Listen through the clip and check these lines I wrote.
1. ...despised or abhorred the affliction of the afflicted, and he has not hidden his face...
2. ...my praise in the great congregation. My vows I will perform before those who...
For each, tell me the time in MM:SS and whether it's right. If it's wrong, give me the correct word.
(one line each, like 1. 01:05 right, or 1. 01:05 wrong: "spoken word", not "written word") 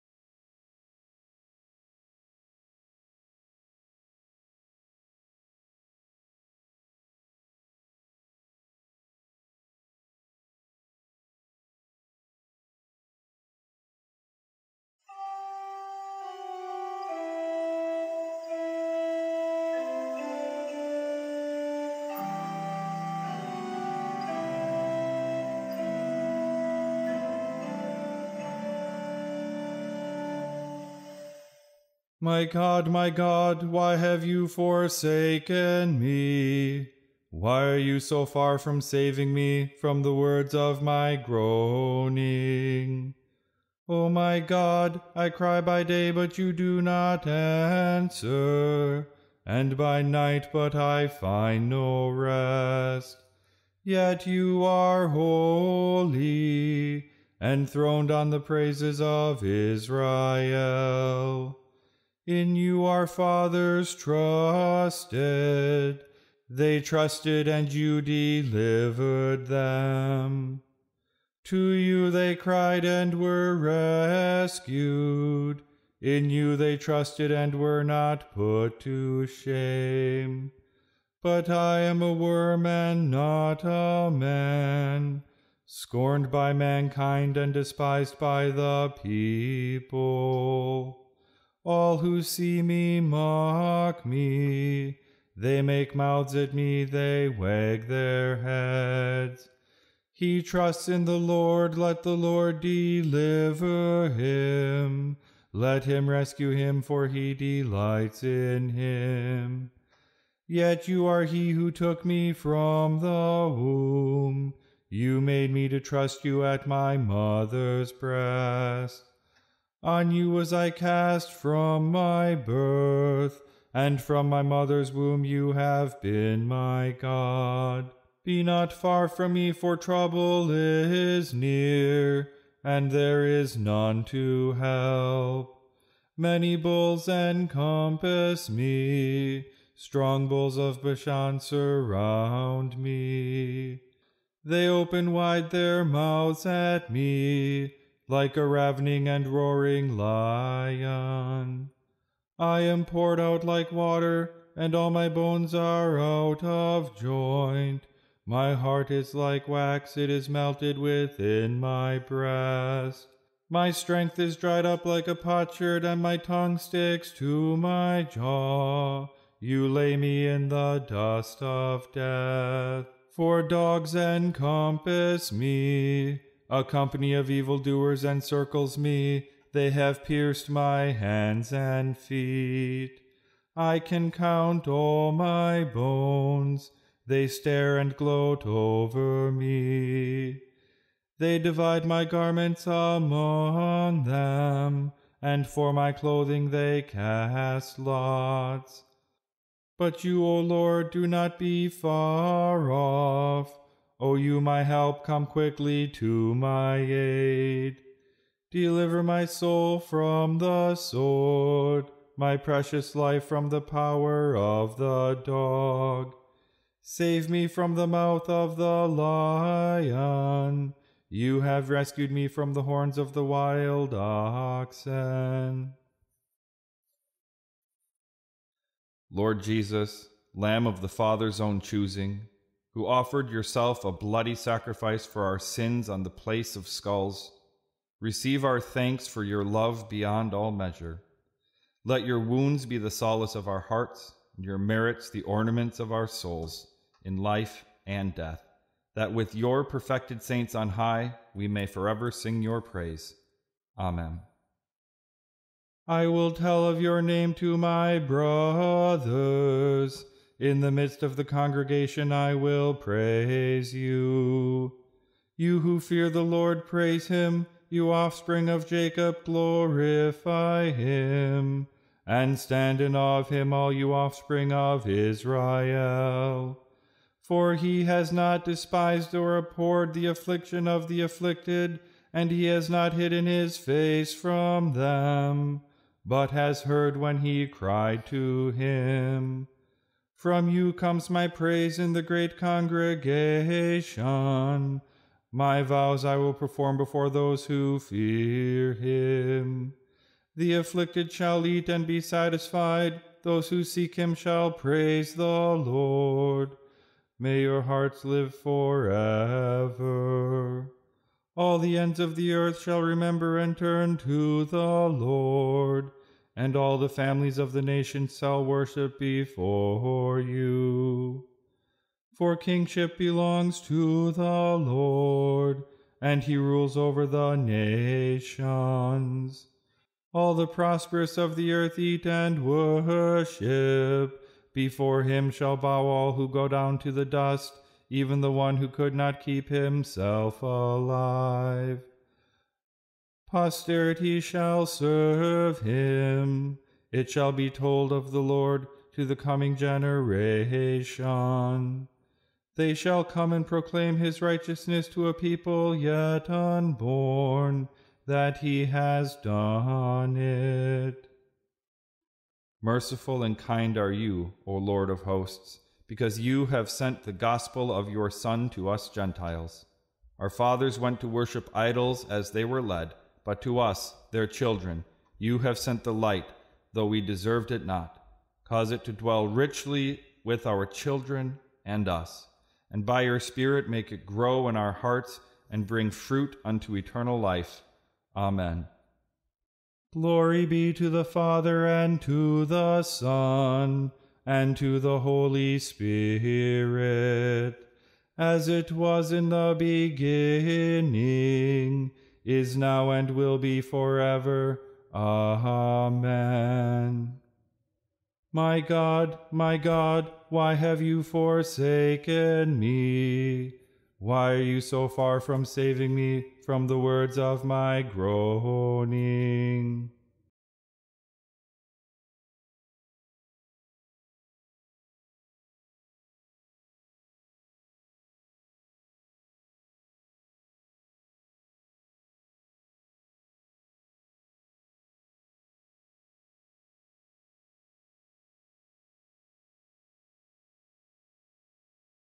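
1. 04:38 right
2. 04:51 right.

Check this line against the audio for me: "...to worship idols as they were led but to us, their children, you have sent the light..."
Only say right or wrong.
right.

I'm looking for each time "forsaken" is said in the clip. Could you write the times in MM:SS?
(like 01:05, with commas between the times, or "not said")
00:34, 06:51.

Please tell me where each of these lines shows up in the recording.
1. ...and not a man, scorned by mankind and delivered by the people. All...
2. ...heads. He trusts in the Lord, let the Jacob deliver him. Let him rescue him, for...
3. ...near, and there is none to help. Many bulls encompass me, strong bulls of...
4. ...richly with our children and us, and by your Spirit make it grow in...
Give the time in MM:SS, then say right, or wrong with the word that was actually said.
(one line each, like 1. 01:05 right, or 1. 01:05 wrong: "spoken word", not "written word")
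1. 01:22 wrong: "despised", not "delivered"
2. 01:38 wrong: "Lord", not "Jacob"
3. 02:11 right
4. 06:19 right.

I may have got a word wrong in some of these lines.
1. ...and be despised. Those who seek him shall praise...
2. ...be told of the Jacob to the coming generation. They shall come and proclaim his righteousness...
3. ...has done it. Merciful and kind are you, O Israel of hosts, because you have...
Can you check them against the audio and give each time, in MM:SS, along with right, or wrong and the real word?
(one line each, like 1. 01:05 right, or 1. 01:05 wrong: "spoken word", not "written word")
1. 05:01 wrong: "satisfied", not "despised"
2. 05:47 wrong: "Lord", not "Jacob"
3. 05:58 wrong: "Lord", not "Israel".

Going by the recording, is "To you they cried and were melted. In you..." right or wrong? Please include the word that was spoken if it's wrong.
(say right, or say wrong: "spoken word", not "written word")
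wrong: "rescued", not "melted".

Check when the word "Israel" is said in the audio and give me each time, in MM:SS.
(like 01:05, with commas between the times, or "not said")
00:59, 04:34.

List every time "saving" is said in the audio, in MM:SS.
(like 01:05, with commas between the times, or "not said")
00:38, 06:55.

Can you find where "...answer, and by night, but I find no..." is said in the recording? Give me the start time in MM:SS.
00:47.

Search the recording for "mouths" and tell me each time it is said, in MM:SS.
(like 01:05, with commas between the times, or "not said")
01:35, 02:25, 03:37.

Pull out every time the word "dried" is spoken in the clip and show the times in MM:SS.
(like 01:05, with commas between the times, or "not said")
02:44.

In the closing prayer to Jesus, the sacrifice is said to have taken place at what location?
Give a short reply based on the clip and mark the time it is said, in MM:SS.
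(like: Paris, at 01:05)
The place of skulls, at 03:56.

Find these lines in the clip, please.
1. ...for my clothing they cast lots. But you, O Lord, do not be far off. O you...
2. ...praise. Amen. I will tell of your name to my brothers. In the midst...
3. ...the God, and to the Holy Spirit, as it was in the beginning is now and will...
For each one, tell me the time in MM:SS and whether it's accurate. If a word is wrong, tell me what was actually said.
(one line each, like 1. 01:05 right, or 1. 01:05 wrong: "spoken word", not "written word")
1. 03:15 right
2. 04:12 right
3. 06:32 wrong: "Son", not "God".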